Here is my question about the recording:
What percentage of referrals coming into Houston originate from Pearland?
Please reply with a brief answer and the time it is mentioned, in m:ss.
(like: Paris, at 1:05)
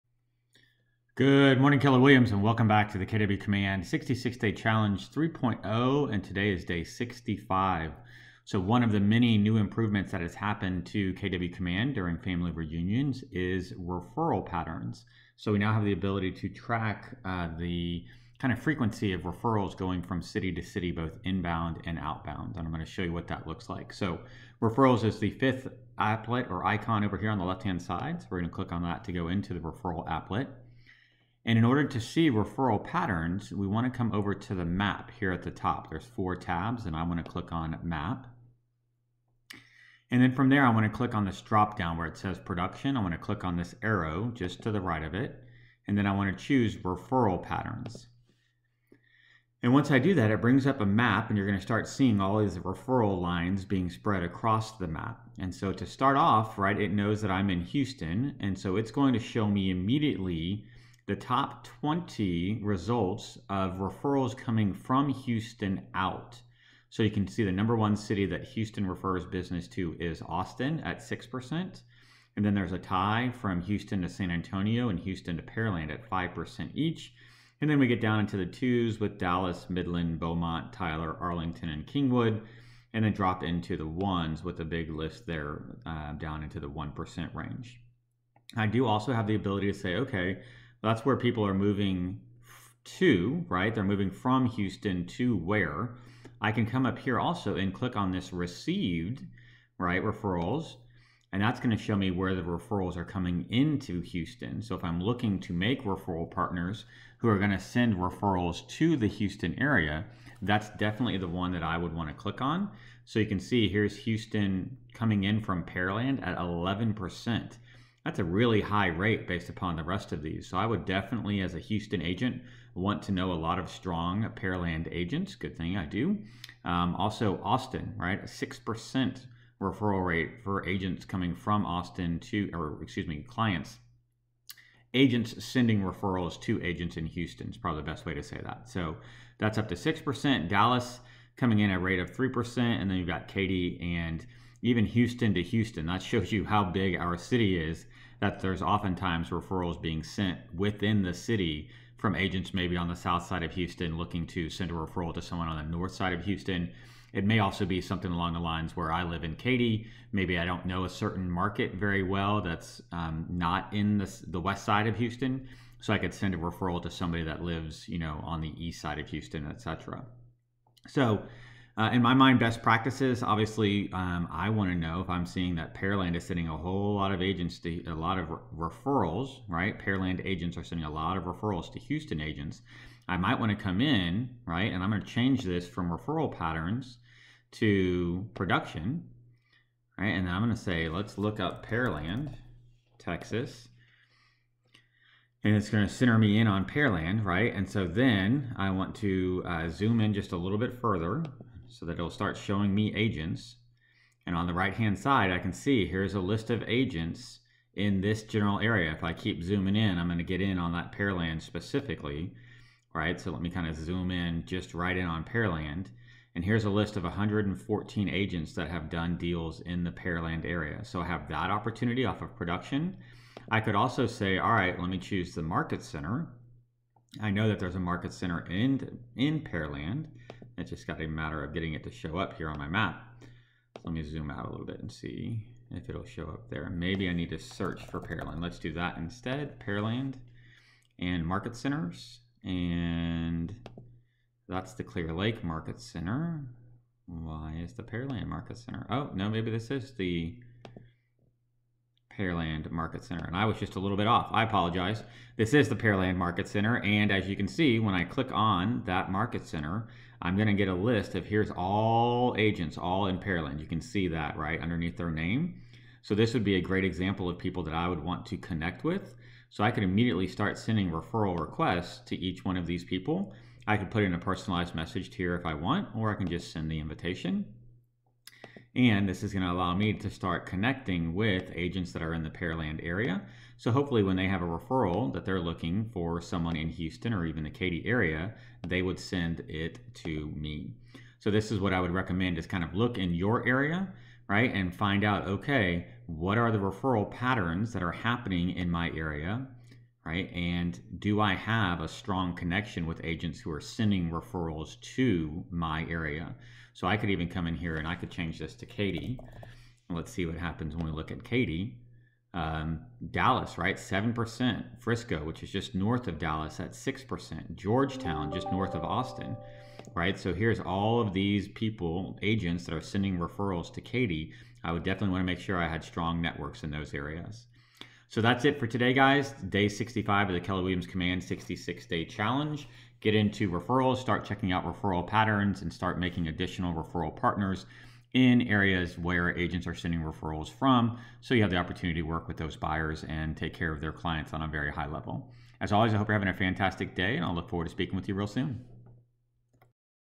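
11%, at 1:56.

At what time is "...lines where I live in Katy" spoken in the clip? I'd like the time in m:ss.
2:38.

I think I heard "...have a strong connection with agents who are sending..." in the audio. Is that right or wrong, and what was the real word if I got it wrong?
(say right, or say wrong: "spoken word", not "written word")
right.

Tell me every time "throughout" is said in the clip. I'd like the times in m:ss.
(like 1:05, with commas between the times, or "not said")
not said.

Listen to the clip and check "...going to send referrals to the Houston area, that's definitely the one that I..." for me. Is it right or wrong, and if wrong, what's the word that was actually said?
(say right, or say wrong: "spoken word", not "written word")
right.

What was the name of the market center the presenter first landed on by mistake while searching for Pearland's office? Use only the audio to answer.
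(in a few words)
Clear Lake.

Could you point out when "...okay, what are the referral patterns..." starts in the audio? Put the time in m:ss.
4:55.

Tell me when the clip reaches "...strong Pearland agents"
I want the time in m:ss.
2:03.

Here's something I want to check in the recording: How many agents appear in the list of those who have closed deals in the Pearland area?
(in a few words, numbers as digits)
114.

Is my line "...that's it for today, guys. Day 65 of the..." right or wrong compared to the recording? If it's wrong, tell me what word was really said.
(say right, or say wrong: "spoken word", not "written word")
right.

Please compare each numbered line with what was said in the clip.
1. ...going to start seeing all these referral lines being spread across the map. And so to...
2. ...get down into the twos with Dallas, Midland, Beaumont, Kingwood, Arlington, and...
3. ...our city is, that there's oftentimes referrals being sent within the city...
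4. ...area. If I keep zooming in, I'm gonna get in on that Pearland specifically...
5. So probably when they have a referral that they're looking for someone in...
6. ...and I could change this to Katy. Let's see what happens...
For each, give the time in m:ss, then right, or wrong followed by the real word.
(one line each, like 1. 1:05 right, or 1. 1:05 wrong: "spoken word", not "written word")
1. 0:51 right
2. 1:17 wrong: "Tyler", not "Kingwood"
3. 2:26 right
4. 3:28 right
5. 4:43 wrong: "hopefully", not "probably"
6. 5:07 right.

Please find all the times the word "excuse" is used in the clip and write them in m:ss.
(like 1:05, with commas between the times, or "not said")
2:12.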